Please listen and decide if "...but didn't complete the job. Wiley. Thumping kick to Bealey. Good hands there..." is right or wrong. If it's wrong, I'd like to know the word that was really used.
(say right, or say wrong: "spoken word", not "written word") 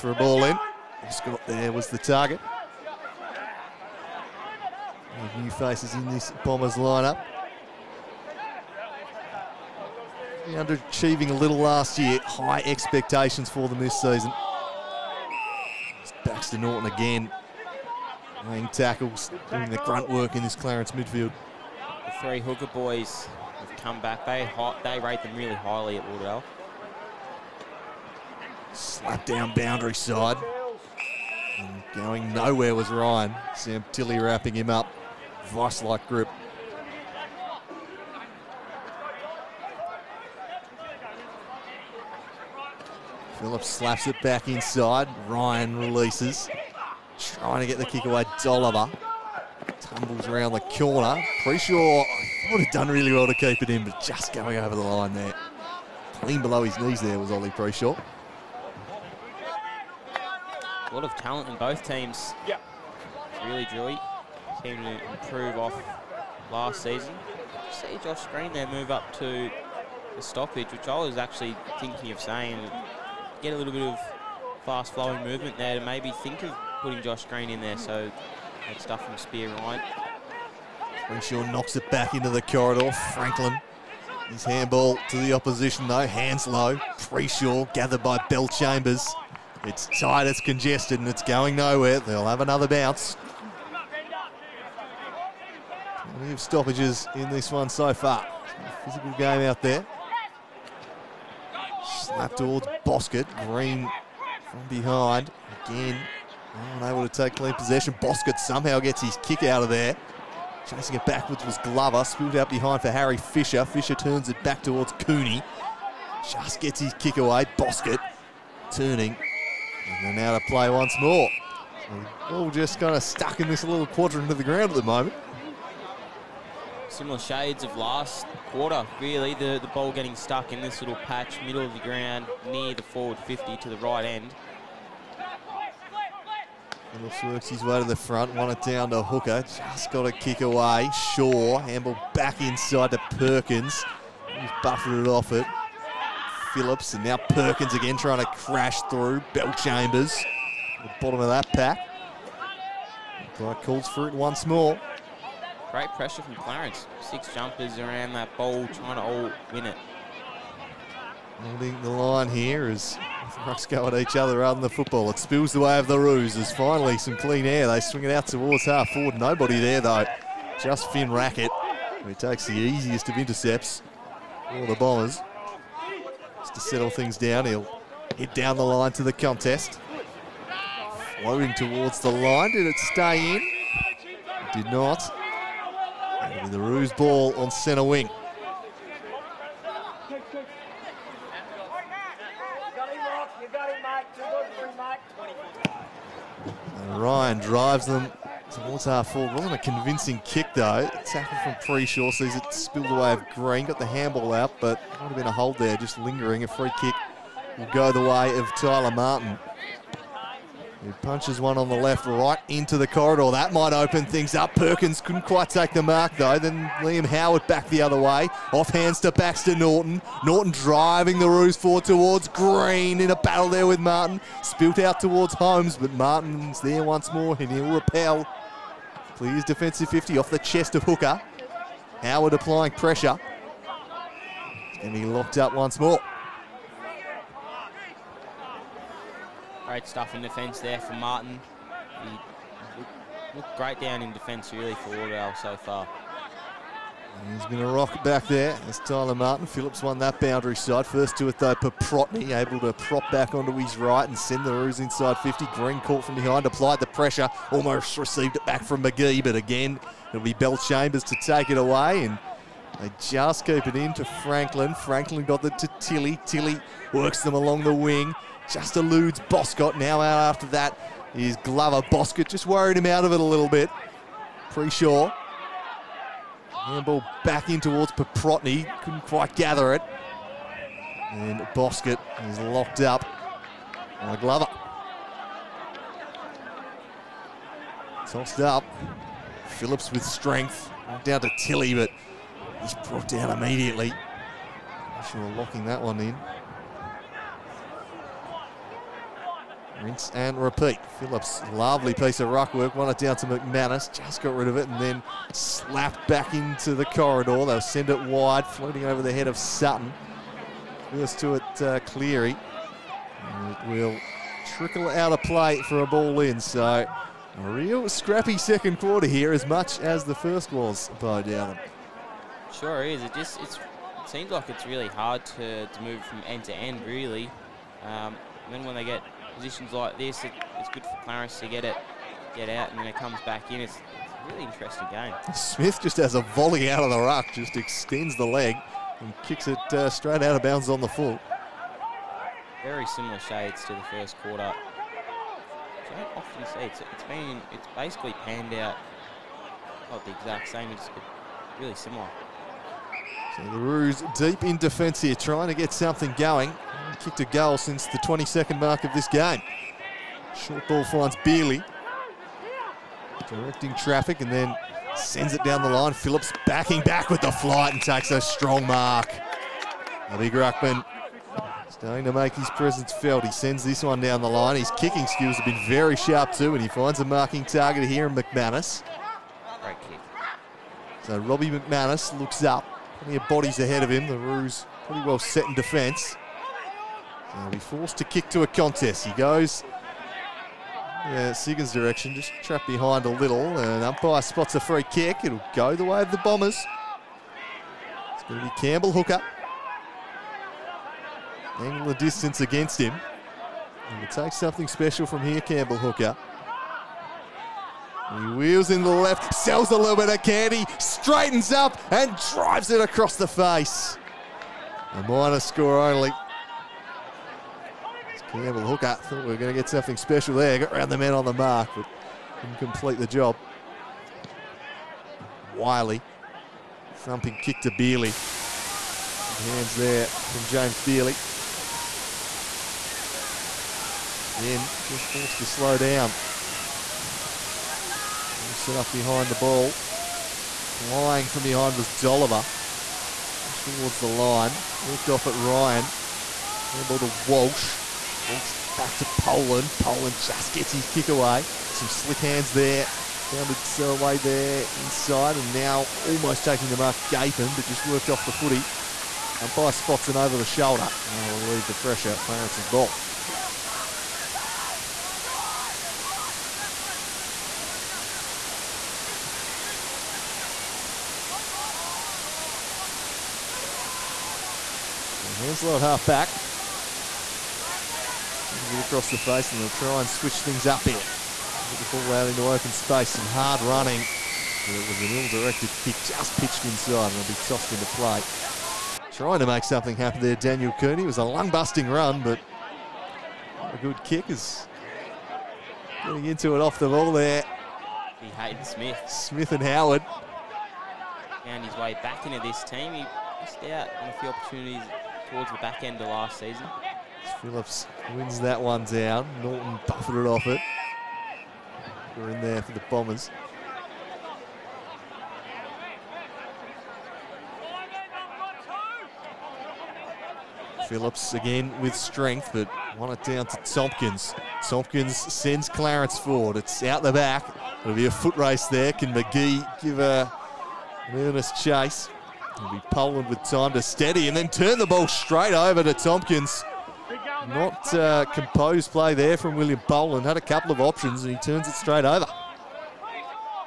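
right.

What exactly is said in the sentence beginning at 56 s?
Clean below his knees there was Ollie sure.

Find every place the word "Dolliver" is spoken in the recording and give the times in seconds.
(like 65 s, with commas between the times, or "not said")
48 s, 441 s.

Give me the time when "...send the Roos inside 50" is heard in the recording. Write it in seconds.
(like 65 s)
254 s.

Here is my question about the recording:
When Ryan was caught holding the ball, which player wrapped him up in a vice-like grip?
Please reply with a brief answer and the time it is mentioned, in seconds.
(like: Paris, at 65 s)
Sam Tilly, at 33 s.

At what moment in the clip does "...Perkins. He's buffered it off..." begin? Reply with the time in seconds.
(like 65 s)
143 s.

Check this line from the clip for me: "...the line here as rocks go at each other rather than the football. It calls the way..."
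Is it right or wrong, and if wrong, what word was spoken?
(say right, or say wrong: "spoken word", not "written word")
wrong: "spills", not "calls".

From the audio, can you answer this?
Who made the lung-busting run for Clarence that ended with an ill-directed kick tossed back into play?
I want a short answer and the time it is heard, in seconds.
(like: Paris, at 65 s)
Daniel Cooney, at 490 s.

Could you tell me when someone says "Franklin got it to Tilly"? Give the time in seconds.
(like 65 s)
264 s.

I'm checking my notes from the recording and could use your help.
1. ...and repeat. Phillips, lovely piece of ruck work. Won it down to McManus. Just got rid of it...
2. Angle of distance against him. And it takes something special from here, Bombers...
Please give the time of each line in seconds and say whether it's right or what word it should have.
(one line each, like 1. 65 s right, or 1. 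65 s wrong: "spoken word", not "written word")
1. 300 s right
2. 401 s wrong: "Campbell", not "Bombers".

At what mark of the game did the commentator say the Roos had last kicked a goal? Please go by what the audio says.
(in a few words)
22nd mark.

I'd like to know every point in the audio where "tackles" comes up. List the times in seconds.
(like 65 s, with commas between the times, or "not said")
18 s, 201 s.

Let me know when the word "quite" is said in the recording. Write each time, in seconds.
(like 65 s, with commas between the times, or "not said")
215 s, 279 s.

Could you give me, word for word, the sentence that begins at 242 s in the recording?
He looked great down in defence really for Lauderdale so far.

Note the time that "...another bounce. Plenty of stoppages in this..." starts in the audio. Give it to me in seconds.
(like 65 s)
92 s.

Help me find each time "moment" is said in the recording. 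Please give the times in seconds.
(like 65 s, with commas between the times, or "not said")
124 s.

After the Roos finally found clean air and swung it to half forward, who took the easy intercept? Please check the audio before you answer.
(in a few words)
Finn Racket.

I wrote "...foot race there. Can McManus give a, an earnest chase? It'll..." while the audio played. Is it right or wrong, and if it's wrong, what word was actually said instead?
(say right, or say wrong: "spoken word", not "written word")
wrong: "McGee", not "McManus".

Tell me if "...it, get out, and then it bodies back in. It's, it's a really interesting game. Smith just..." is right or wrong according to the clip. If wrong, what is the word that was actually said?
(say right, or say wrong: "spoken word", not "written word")
wrong: "comes", not "bodies".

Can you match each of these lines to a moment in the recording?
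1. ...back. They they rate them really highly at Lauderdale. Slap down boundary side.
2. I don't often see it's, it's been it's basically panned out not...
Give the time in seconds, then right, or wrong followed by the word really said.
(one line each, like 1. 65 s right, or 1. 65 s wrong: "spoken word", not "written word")
1. 24 s right
2. 344 s right.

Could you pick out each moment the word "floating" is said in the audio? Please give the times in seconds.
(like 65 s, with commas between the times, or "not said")
181 s, 308 s.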